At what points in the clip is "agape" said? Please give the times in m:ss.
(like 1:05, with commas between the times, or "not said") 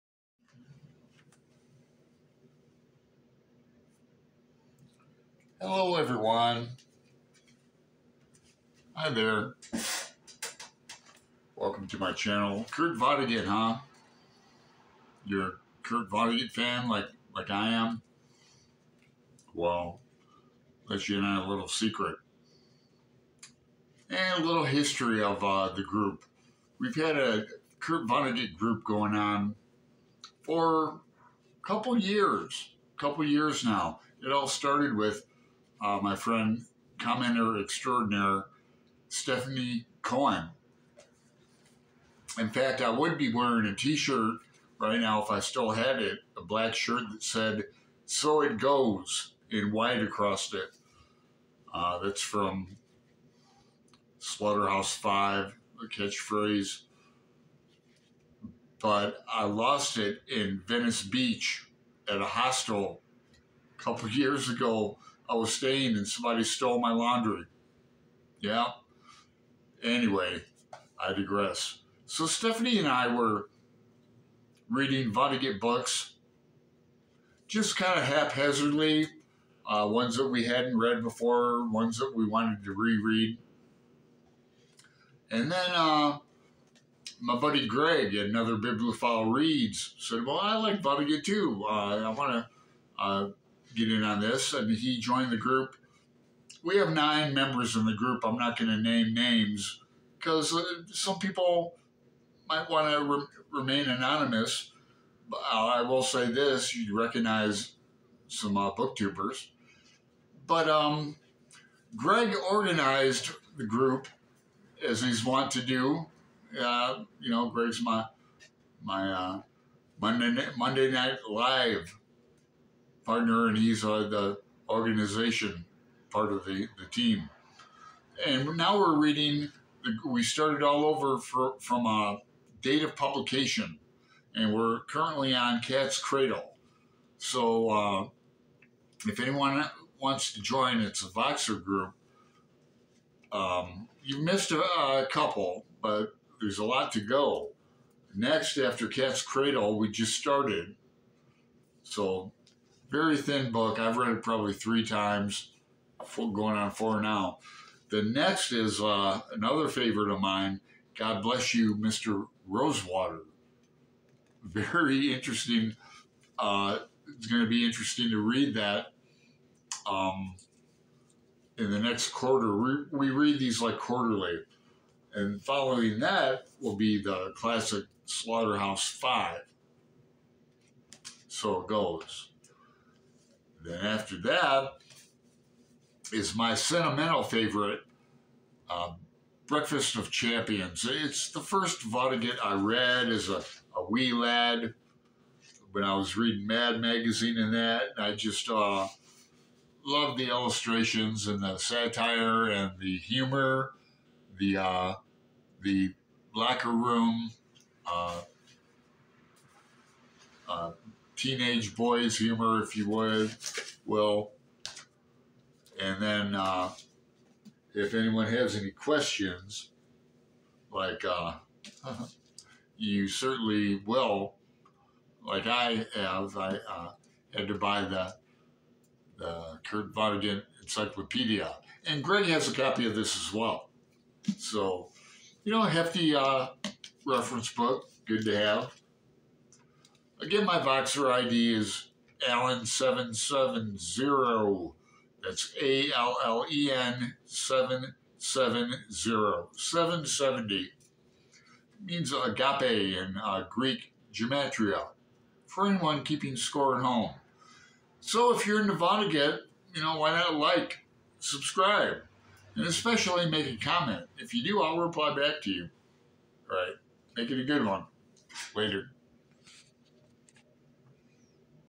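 4:12.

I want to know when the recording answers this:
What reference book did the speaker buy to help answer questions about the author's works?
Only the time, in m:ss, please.
3:49.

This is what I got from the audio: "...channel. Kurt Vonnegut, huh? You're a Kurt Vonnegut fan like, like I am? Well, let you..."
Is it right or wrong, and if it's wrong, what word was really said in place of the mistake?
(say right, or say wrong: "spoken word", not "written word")
right.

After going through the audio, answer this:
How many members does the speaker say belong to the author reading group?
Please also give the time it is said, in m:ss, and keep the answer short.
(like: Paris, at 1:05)
9, at 1:36.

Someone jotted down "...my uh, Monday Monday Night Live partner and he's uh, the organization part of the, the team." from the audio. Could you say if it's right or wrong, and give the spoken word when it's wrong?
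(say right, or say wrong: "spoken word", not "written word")
right.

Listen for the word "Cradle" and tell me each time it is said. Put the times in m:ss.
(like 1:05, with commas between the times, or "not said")
2:15, 2:29.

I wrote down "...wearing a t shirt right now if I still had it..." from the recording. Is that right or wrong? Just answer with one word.
right.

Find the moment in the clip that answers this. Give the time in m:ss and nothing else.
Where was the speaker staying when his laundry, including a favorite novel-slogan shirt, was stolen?
1:00.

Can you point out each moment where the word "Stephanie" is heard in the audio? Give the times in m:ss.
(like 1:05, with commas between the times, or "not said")
0:39, 1:12.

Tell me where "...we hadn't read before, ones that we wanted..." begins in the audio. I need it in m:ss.
1:20.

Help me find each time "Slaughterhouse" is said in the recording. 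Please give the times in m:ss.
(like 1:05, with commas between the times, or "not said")
0:54, 2:58.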